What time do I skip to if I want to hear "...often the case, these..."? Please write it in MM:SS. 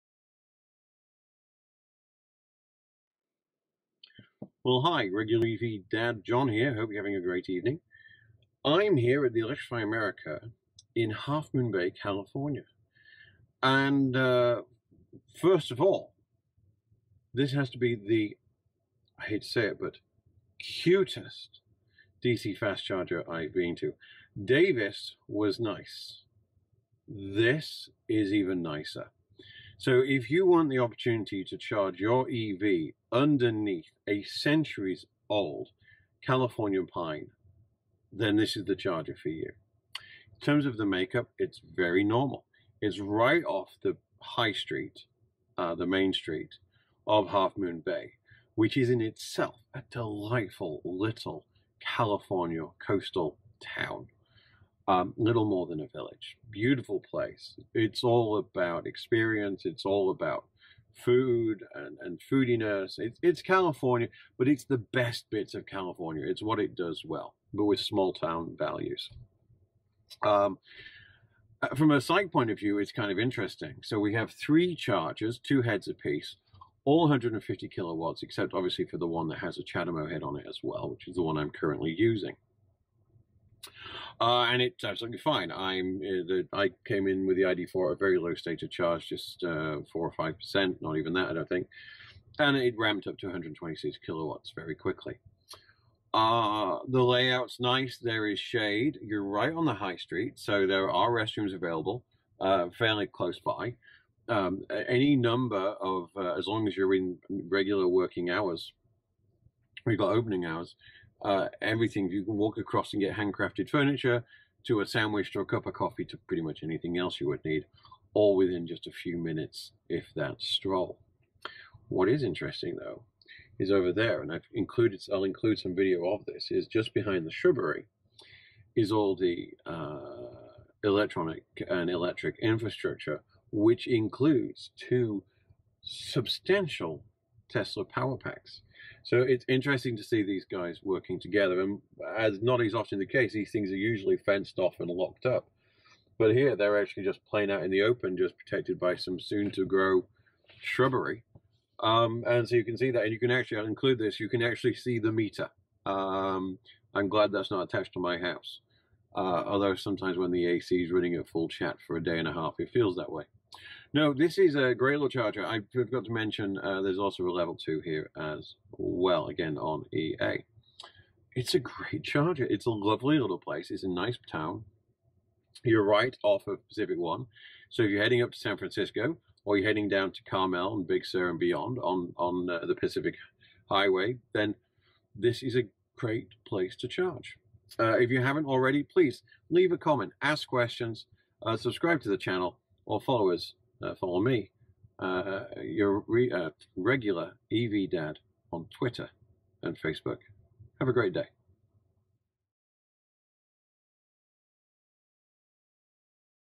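02:22.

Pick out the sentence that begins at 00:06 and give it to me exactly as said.
Hope you're having a great evening.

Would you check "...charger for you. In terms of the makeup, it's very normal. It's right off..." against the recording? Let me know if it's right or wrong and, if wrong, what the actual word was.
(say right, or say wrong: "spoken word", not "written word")
right.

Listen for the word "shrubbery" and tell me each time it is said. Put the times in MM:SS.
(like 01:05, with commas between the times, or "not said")
02:07, 02:30.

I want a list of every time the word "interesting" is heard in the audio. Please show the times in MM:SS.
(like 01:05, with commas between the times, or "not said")
01:13, 02:02, 02:19.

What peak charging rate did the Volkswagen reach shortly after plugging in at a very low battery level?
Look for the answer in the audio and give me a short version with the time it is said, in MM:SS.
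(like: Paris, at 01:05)
126 kilowatts, at 01:33.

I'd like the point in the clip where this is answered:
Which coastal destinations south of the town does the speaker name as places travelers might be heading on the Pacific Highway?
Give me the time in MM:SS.
03:00.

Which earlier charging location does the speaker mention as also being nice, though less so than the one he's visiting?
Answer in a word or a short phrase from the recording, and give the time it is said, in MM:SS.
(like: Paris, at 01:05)
Davis, at 00:24.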